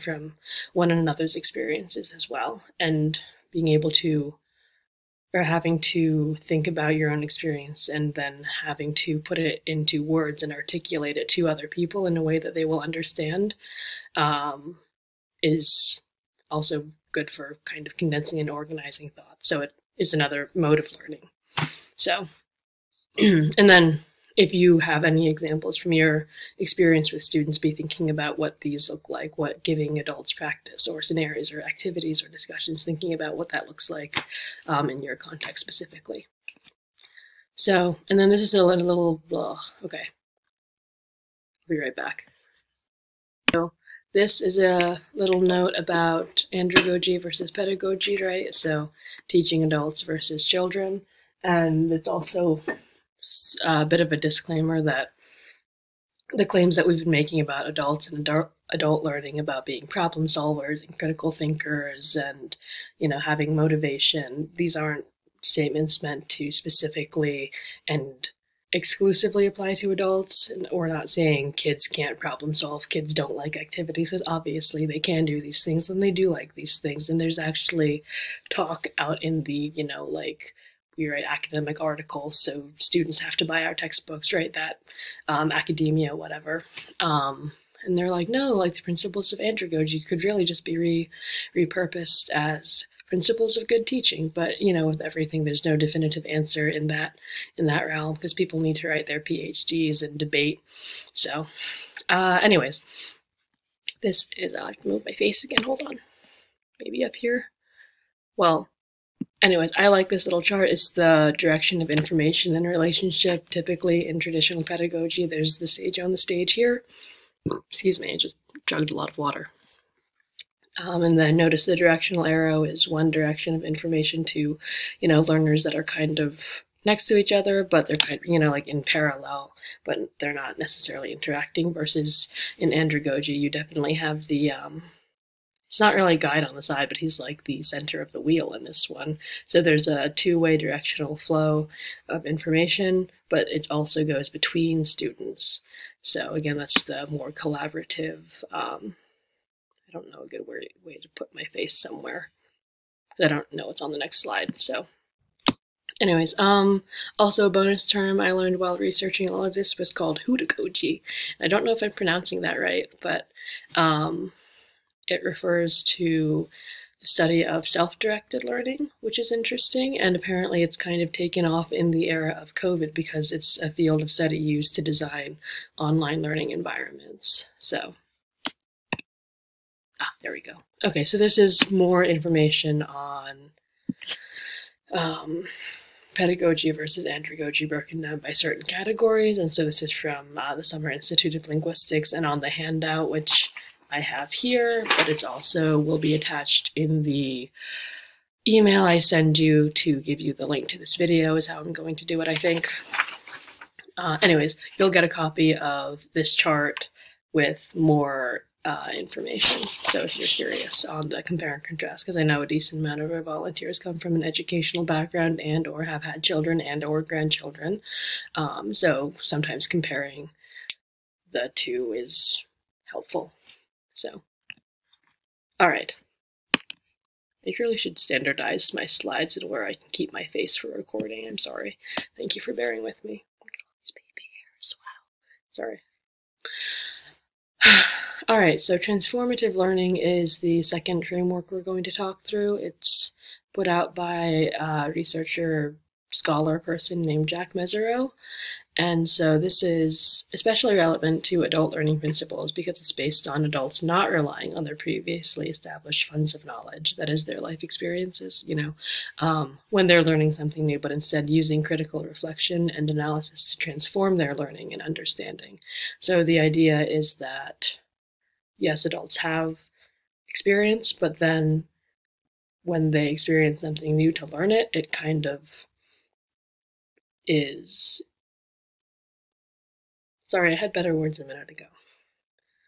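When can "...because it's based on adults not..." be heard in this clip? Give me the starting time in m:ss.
4:12.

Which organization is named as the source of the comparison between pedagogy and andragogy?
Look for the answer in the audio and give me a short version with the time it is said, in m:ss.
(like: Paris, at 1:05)
Summer Institute of Linguistics, at 3:10.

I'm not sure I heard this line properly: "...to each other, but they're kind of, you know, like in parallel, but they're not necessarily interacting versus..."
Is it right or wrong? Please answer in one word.
right.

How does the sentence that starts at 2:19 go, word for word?
So there's a two-way directional flow of information, but it also goes between students.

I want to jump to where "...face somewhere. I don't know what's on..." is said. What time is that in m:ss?
2:31.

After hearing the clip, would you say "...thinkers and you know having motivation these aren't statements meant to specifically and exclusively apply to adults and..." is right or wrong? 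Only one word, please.
right.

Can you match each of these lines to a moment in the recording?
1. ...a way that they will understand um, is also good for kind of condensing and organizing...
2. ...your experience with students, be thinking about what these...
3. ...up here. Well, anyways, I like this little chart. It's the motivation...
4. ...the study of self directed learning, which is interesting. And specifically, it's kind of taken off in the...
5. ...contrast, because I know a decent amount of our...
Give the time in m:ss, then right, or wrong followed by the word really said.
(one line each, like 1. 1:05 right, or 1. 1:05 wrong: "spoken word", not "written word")
1. 0:12 right
2. 0:25 right
3. 1:47 wrong: "direction", not "motivation"
4. 2:47 wrong: "apparently", not "specifically"
5. 3:31 right.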